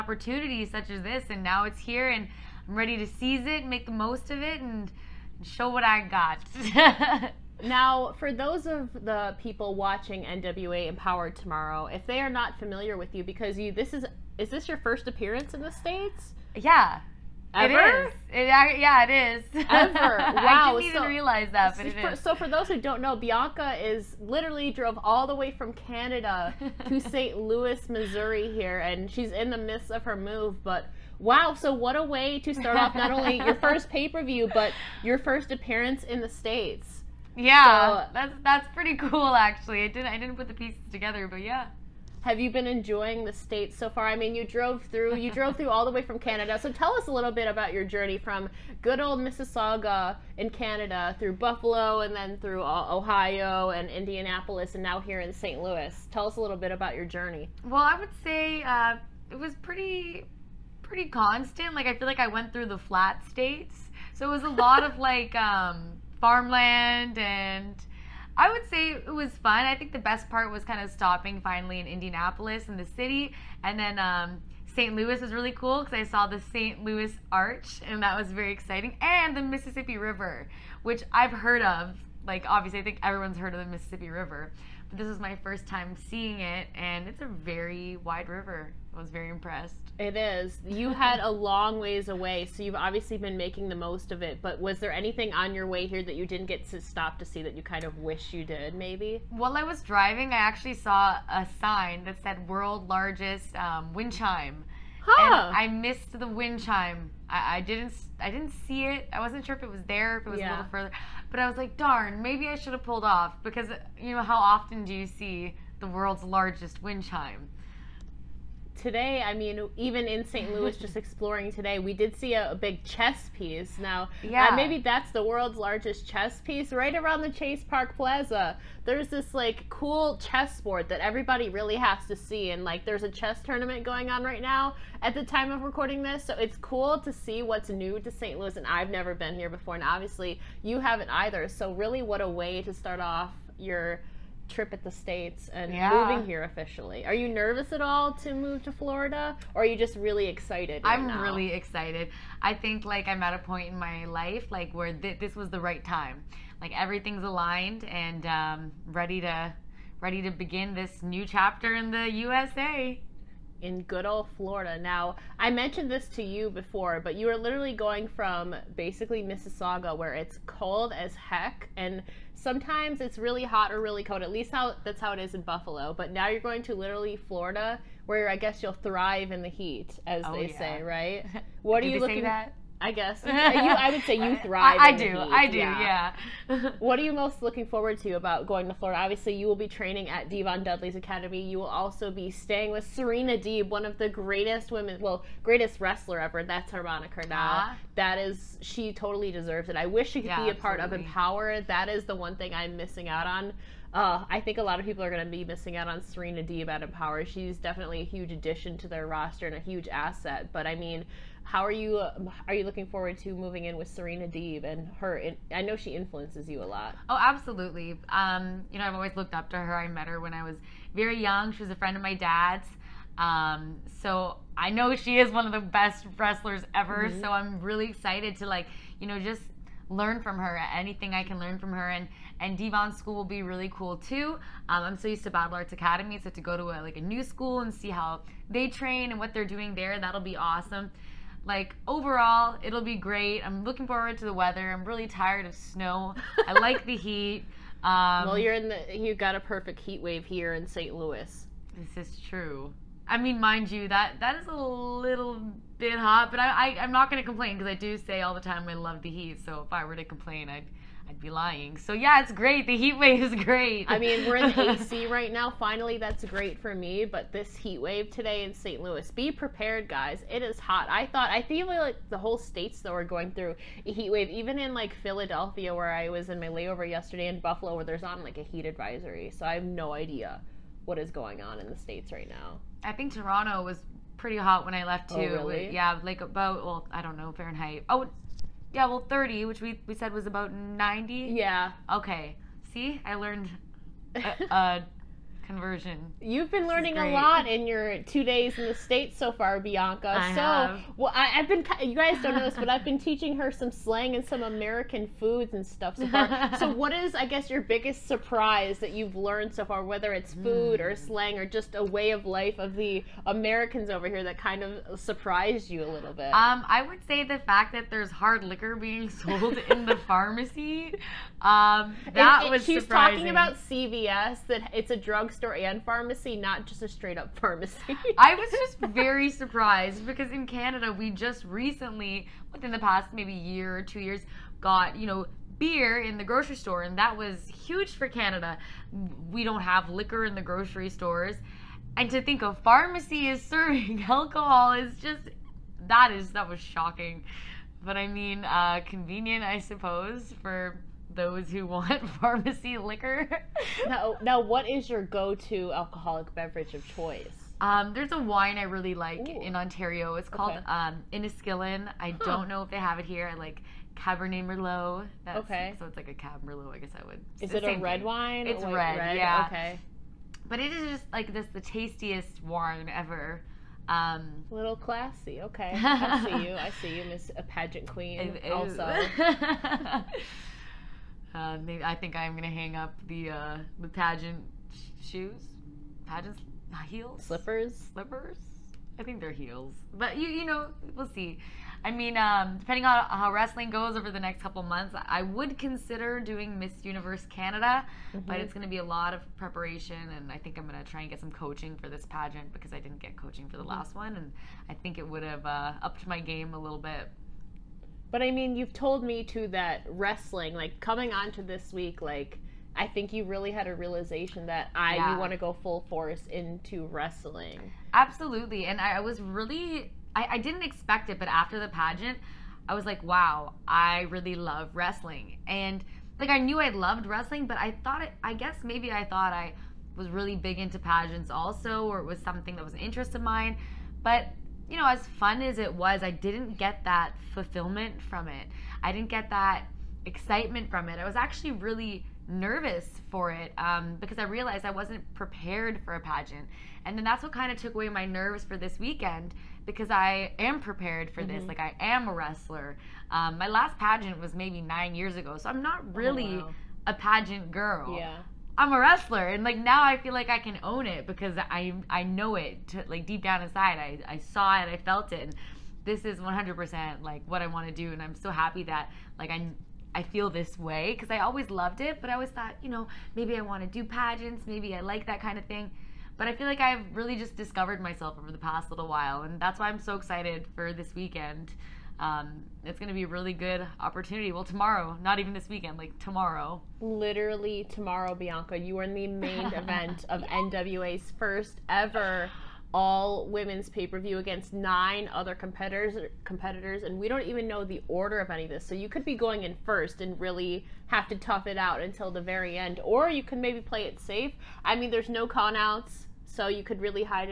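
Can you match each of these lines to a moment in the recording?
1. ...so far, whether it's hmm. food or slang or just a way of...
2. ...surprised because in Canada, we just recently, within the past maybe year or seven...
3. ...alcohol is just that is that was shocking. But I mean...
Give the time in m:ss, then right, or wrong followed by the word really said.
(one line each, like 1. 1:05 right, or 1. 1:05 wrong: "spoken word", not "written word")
1. 5:09 right
2. 5:29 wrong: "two", not "seven"
3. 5:44 right.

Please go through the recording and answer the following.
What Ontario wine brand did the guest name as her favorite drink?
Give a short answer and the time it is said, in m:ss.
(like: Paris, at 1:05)
Inniskillin, at 6:01.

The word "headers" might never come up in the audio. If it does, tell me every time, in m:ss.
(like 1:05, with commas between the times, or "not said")
not said.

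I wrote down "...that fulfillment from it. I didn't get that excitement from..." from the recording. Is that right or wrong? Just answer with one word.
right.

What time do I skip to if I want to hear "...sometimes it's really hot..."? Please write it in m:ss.
2:52.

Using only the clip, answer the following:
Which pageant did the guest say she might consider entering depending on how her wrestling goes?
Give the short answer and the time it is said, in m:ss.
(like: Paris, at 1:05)
Miss Universe Canada, at 6:36.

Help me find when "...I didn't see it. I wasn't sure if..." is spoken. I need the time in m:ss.
1:48.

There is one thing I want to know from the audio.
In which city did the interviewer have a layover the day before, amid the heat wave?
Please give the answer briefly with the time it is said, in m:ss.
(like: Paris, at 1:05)
Philadelphia, at 4:35.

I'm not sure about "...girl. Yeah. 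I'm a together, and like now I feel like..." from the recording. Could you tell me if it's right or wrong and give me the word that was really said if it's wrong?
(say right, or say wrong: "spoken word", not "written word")
wrong: "wrestler", not "together".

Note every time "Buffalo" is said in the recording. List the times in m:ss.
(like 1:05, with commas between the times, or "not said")
0:51, 2:55, 4:37.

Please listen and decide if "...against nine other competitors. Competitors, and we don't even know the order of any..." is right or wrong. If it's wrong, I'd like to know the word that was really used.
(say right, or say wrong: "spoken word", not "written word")
right.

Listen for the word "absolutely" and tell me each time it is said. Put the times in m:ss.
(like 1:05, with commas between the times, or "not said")
3:20, 3:37, 6:57.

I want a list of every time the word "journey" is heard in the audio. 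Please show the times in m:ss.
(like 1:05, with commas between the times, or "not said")
0:47, 0:57.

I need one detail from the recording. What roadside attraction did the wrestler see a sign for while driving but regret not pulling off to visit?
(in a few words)
World's largest wind chime.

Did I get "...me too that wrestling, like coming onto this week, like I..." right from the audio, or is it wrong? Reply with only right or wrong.
right.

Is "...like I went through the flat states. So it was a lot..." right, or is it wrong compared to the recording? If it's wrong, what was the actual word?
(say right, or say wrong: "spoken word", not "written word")
right.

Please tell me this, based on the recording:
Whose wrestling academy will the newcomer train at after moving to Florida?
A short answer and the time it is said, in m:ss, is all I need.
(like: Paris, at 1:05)
Devon Dudley's, at 3:10.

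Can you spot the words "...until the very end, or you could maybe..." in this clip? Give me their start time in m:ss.
8:21.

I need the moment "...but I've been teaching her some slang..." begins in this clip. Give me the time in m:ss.
5:02.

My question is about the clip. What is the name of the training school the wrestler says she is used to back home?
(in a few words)
Battle Arts Academy.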